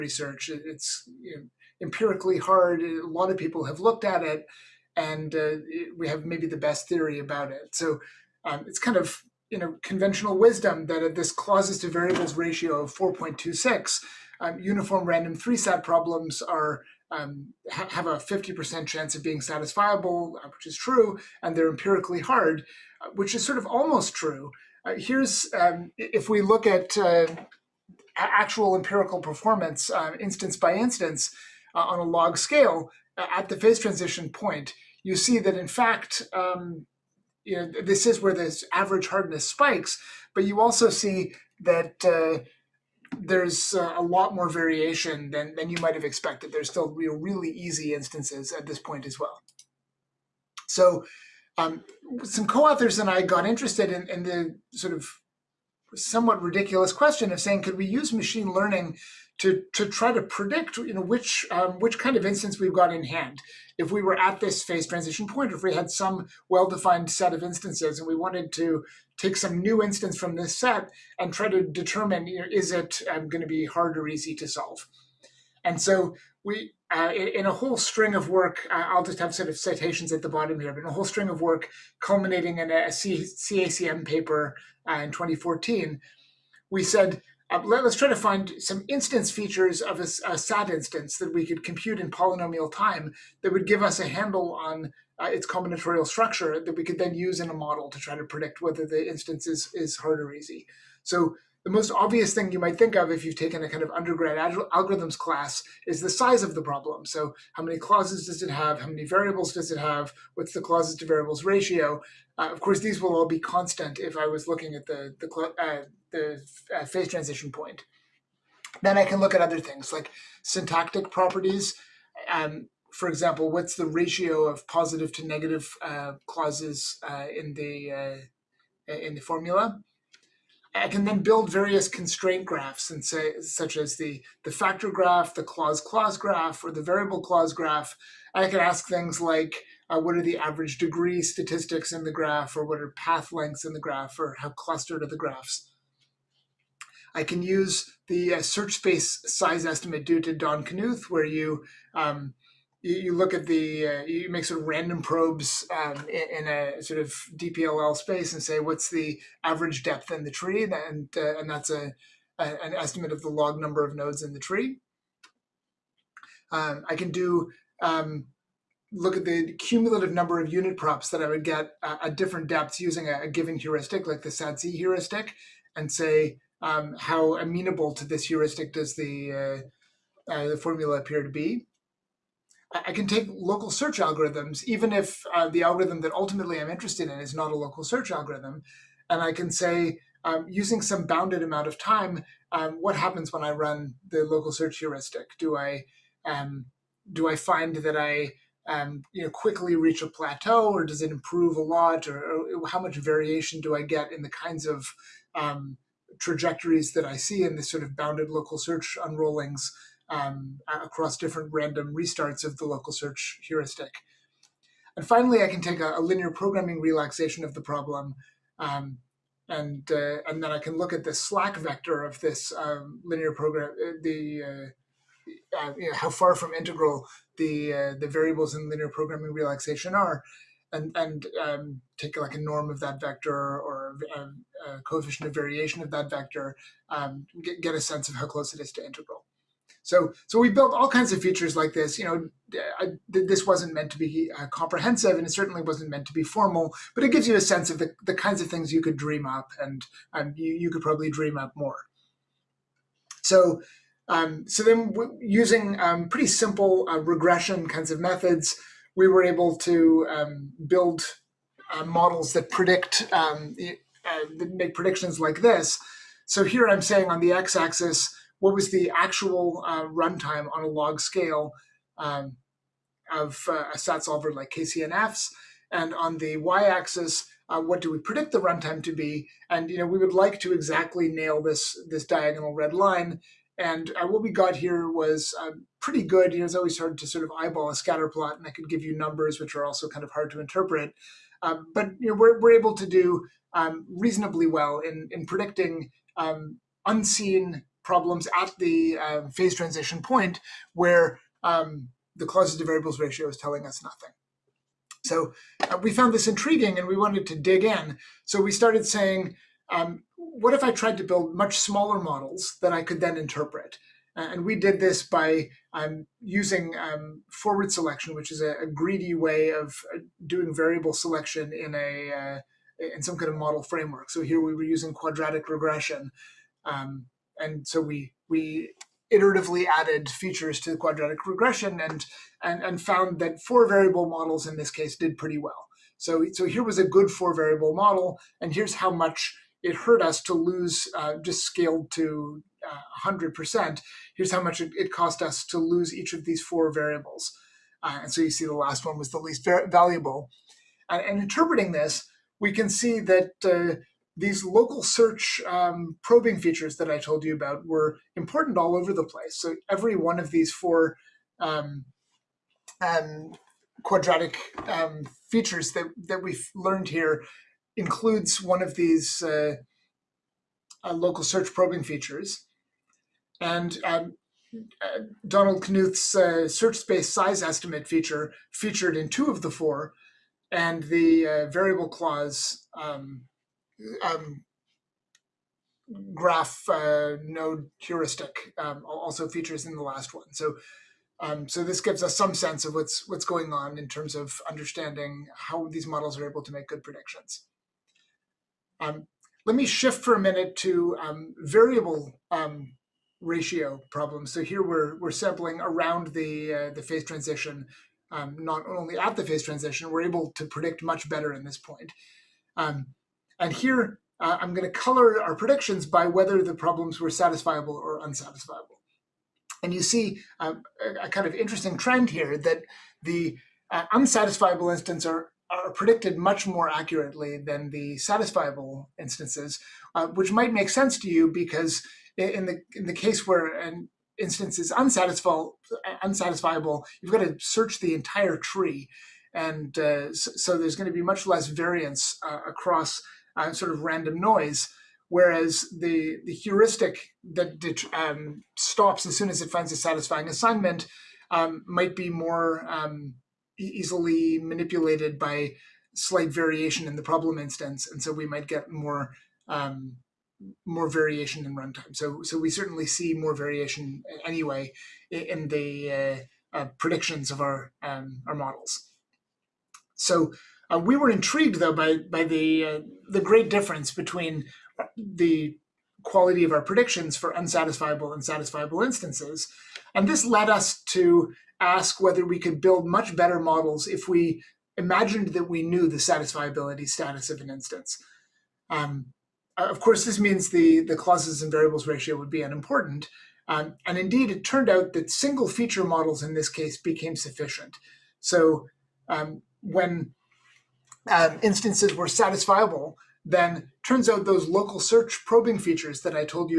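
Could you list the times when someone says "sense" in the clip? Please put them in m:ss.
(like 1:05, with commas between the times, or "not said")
3:57, 4:07, 6:32, 7:10.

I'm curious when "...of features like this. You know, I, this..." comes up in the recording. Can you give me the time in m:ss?
4:01.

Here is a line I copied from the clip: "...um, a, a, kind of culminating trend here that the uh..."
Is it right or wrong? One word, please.
wrong.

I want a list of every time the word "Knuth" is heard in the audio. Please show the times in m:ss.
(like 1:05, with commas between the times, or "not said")
2:30, 6:15.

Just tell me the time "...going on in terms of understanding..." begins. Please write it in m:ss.
6:33.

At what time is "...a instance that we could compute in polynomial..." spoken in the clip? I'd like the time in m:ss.
1:30.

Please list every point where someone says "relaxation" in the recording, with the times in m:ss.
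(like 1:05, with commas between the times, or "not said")
3:36, 3:49.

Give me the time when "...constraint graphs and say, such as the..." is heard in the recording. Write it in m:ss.
2:11.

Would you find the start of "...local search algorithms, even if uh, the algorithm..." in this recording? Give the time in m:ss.
3:03.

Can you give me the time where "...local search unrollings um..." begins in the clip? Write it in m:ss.
3:28.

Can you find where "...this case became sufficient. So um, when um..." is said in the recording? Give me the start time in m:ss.
8:16.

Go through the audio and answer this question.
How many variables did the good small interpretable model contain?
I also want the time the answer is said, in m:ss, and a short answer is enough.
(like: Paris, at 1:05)
4, at 5:33.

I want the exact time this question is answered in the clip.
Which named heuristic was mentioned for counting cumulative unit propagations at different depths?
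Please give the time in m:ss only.
2:54.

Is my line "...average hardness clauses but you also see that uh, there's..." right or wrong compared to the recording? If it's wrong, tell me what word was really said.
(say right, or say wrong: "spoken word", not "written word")
wrong: "spikes", not "clauses".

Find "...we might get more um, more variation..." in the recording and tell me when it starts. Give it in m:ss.
7:38.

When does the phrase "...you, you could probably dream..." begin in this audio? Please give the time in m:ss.
4:10.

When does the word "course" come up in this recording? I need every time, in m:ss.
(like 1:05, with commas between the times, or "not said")
1:52, 8:09.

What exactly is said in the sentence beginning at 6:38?
Um, let me shift for a minute to um, variable um, ratio problems.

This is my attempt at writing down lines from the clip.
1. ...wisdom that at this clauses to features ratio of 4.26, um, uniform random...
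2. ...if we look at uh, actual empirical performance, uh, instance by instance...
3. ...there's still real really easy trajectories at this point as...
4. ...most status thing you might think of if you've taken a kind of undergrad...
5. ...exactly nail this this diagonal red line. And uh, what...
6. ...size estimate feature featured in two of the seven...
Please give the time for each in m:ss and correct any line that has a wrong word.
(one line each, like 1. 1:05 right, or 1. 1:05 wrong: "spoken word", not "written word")
1. 0:10 wrong: "variables", not "features"
2. 0:25 right
3. 0:46 wrong: "instances", not "trajectories"
4. 1:41 wrong: "obvious", not "status"
5. 4:40 right
6. 6:17 wrong: "four", not "seven".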